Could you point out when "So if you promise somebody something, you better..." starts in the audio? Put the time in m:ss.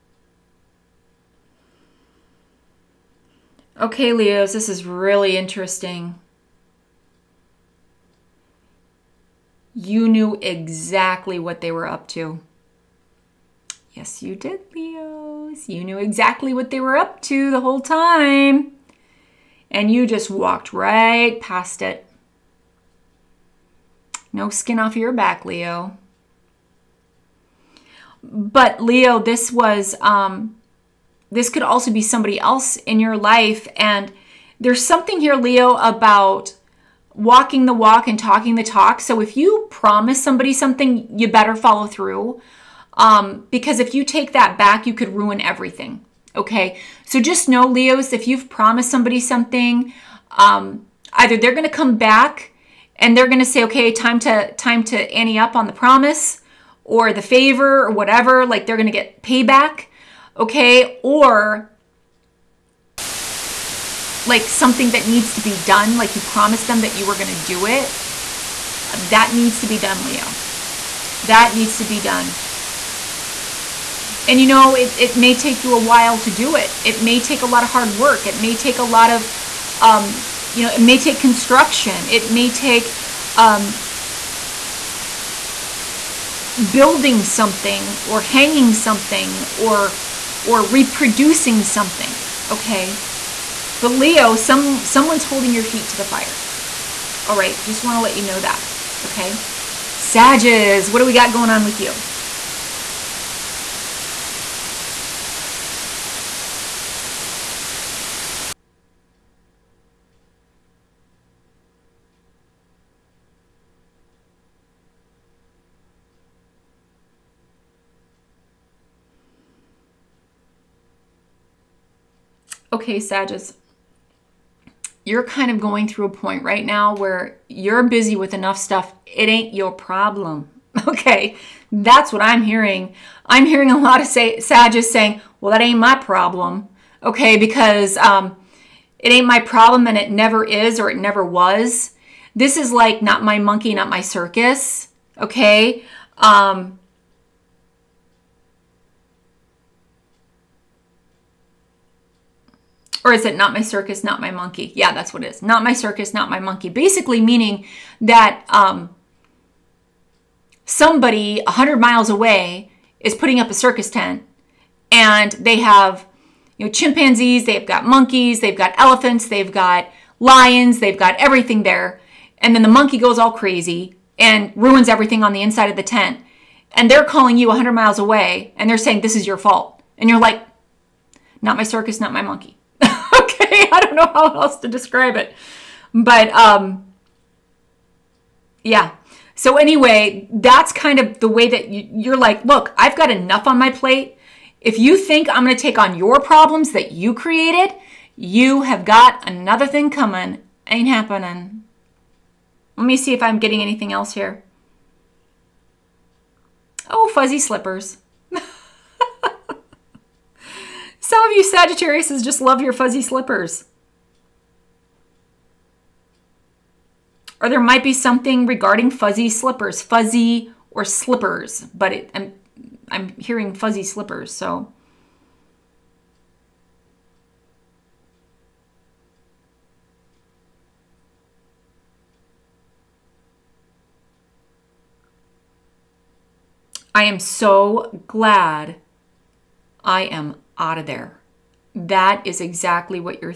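0:39.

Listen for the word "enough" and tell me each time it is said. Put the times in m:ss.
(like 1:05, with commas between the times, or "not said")
2:08, 3:13.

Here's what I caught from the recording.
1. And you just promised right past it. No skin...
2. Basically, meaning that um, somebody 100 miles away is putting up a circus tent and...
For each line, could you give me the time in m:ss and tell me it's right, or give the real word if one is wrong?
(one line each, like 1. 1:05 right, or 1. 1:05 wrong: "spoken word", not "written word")
1. 0:19 wrong: "walked", not "promised"
2. 2:36 right.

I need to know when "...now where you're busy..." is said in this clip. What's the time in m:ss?
2:06.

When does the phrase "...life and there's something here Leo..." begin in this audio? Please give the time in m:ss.
0:33.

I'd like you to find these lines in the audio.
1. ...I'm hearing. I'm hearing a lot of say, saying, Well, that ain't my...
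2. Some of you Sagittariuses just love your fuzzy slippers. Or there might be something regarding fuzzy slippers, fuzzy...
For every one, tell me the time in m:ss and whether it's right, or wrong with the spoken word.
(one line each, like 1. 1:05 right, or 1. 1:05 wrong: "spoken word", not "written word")
1. 2:12 right
2. 3:31 right.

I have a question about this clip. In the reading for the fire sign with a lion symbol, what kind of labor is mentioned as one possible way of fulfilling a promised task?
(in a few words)
construction.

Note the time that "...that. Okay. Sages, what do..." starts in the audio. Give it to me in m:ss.
1:38.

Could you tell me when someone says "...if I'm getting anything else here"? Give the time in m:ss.
3:23.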